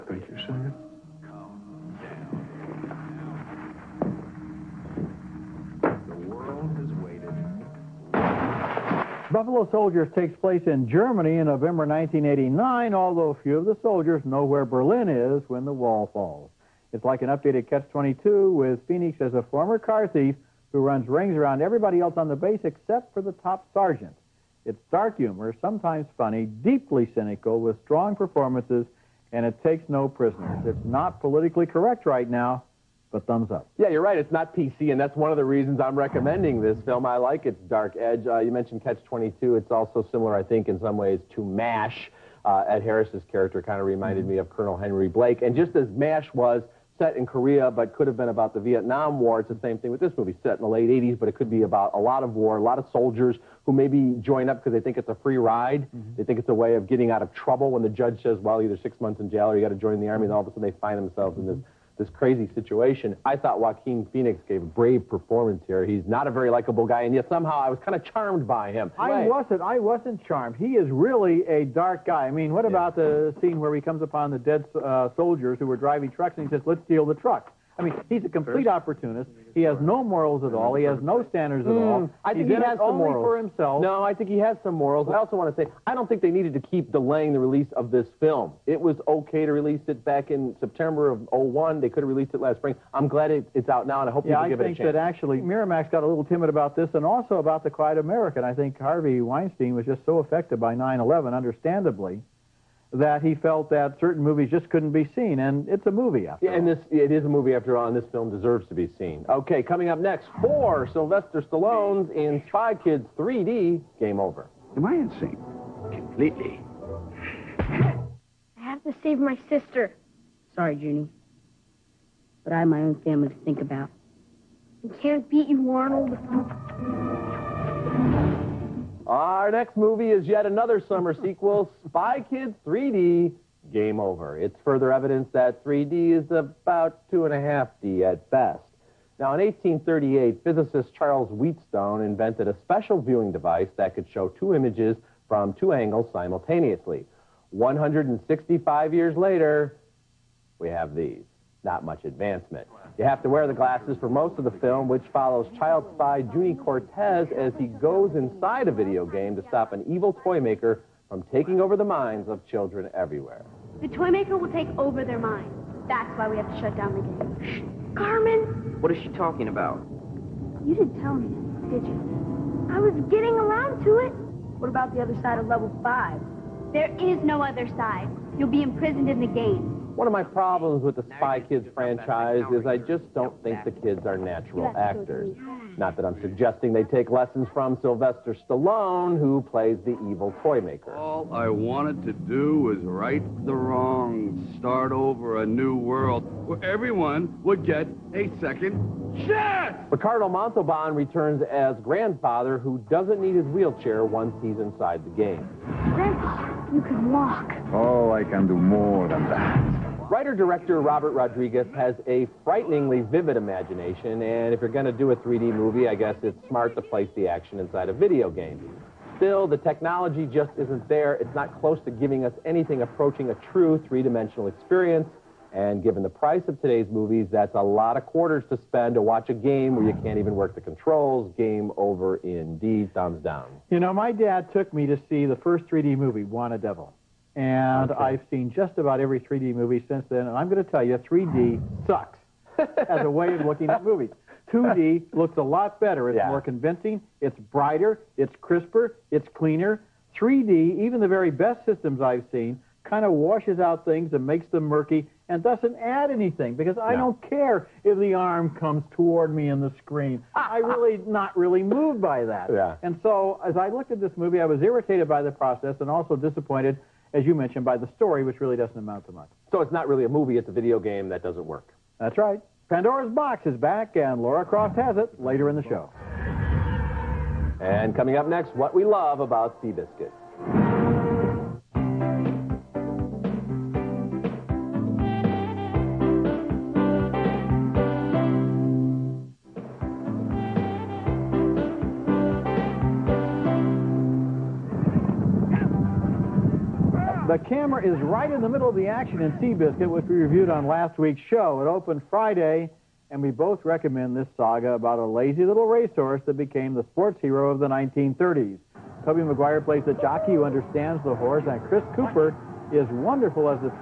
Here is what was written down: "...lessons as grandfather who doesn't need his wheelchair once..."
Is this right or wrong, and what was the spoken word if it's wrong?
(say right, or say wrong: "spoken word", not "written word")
wrong: "returns", not "lessons".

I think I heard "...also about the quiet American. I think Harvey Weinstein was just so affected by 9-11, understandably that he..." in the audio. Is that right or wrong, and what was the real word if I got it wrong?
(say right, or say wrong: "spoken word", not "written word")
right.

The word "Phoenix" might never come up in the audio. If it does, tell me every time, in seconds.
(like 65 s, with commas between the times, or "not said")
18 s, 64 s.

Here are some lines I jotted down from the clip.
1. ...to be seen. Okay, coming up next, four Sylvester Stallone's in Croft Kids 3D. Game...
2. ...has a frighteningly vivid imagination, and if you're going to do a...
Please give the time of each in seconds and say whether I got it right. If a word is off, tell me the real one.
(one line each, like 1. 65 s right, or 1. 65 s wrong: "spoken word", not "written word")
1. 108 s wrong: "Spy", not "Croft"
2. 211 s right.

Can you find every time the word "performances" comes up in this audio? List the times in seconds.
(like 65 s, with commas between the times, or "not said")
28 s, 65 s.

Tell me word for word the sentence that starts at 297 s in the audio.
The camera is right in the middle of the action in Seabiscuit, which we reviewed on last week's show.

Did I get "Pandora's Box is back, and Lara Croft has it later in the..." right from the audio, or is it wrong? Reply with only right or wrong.
right.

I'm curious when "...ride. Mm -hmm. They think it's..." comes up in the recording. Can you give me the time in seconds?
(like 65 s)
55 s.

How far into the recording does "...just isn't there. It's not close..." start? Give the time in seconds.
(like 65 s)
220 s.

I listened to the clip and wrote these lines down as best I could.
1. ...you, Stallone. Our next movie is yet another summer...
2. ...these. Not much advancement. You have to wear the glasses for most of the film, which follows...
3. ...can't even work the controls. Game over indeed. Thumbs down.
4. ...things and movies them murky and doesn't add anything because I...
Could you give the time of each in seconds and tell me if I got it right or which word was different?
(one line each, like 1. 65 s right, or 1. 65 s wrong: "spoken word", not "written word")
1. 125 s wrong: "Arnold", not "Stallone"
2. 150 s right
3. 230 s right
4. 253 s wrong: "makes", not "movies".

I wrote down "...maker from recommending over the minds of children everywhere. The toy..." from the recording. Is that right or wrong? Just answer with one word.
wrong.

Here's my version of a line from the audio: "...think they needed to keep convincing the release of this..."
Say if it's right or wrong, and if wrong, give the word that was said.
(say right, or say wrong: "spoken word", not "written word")
wrong: "delaying", not "convincing".